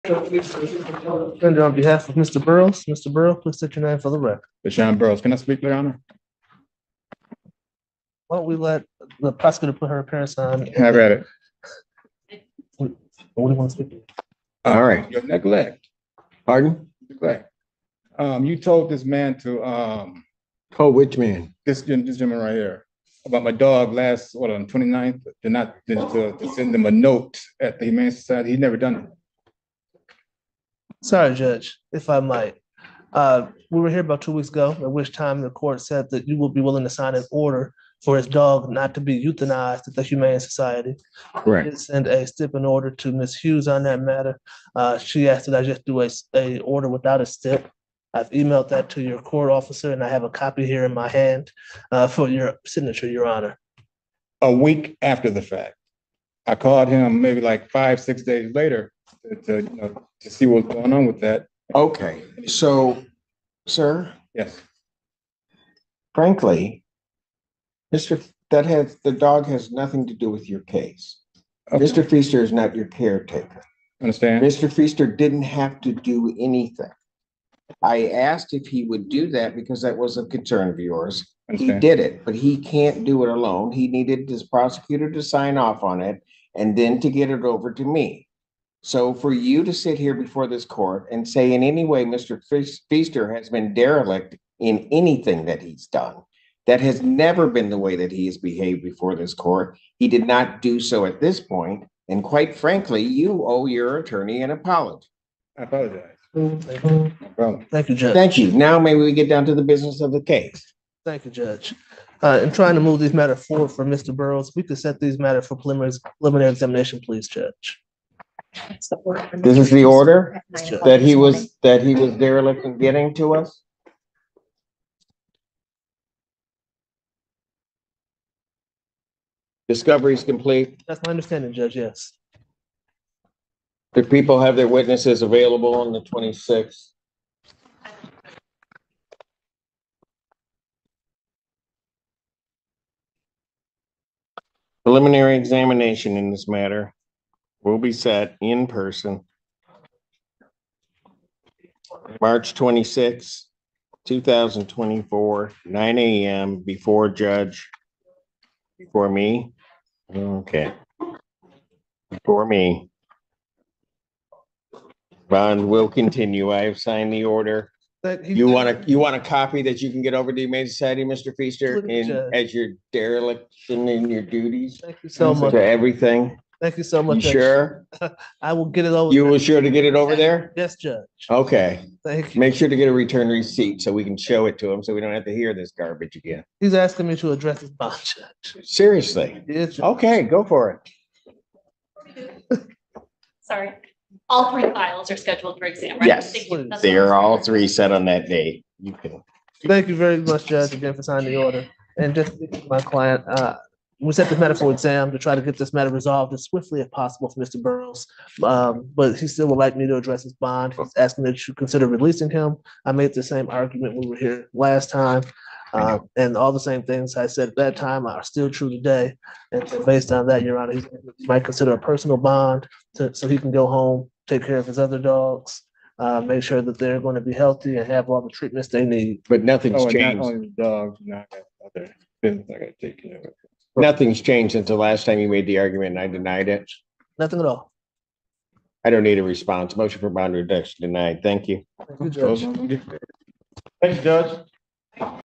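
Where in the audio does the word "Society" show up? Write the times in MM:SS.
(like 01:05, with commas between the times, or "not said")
00:28, 00:40, 02:50.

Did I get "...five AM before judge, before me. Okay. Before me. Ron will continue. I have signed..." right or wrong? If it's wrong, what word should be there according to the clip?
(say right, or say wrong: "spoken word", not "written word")
wrong: "nine", not "five".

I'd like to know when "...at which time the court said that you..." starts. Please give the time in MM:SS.
00:34.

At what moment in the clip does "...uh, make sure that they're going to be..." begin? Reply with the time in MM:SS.
03:45.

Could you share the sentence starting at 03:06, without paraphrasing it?
He's asking me to address his bond, Judge.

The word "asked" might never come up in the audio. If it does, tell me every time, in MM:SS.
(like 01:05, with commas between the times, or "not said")
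00:45, 01:18.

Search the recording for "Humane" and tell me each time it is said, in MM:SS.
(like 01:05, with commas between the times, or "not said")
00:27, 00:40, 02:50.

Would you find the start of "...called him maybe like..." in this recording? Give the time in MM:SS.
00:56.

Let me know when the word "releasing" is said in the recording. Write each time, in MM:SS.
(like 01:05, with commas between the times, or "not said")
03:31.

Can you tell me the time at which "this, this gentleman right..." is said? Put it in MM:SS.
00:21.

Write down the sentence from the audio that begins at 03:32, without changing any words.
I made the same argument when we were here last time.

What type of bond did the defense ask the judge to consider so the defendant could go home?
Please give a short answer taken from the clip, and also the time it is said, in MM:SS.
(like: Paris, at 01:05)
Personal bond, at 03:41.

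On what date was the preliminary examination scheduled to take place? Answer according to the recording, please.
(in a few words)
March 26, 2024.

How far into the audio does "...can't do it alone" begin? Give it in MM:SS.
01:22.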